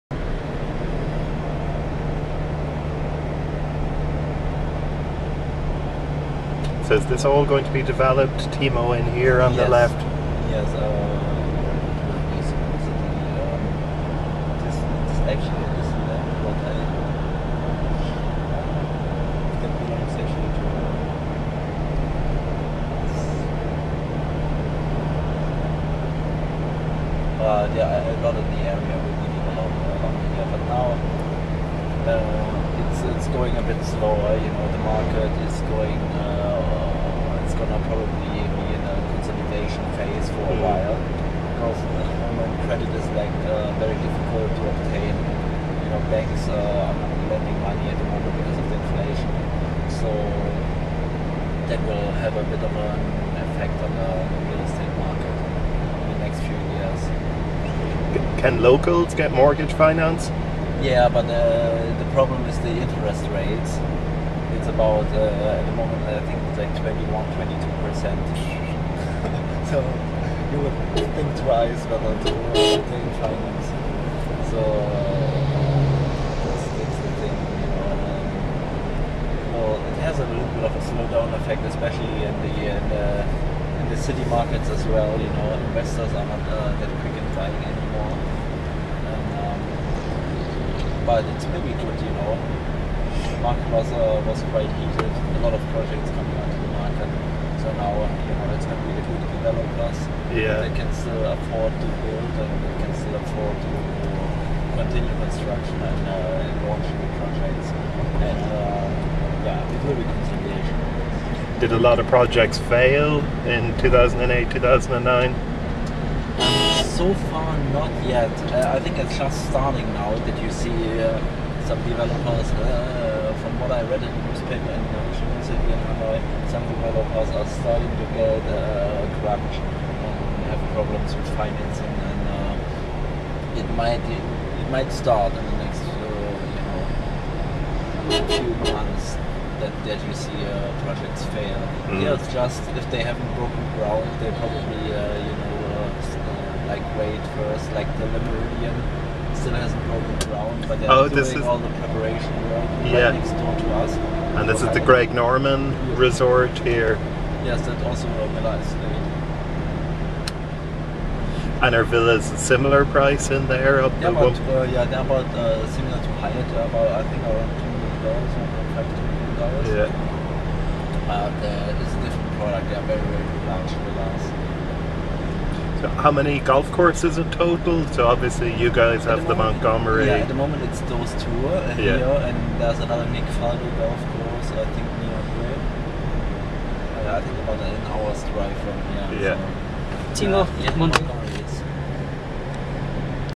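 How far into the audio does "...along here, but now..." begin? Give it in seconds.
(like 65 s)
29 s.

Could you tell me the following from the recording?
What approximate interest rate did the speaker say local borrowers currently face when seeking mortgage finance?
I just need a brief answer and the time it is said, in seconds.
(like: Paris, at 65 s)
21-22%, at 66 s.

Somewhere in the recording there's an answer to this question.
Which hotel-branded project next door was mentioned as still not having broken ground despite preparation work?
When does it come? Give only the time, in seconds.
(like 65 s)
148 s.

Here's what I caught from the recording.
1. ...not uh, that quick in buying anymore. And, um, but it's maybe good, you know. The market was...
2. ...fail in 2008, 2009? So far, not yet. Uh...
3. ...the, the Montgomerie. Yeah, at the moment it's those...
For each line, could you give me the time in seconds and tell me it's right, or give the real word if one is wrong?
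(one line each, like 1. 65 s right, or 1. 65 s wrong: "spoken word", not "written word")
1. 86 s right
2. 112 s right
3. 179 s right.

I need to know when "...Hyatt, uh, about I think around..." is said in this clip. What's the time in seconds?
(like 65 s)
166 s.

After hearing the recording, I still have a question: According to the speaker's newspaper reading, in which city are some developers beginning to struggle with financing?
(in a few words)
Hanoi.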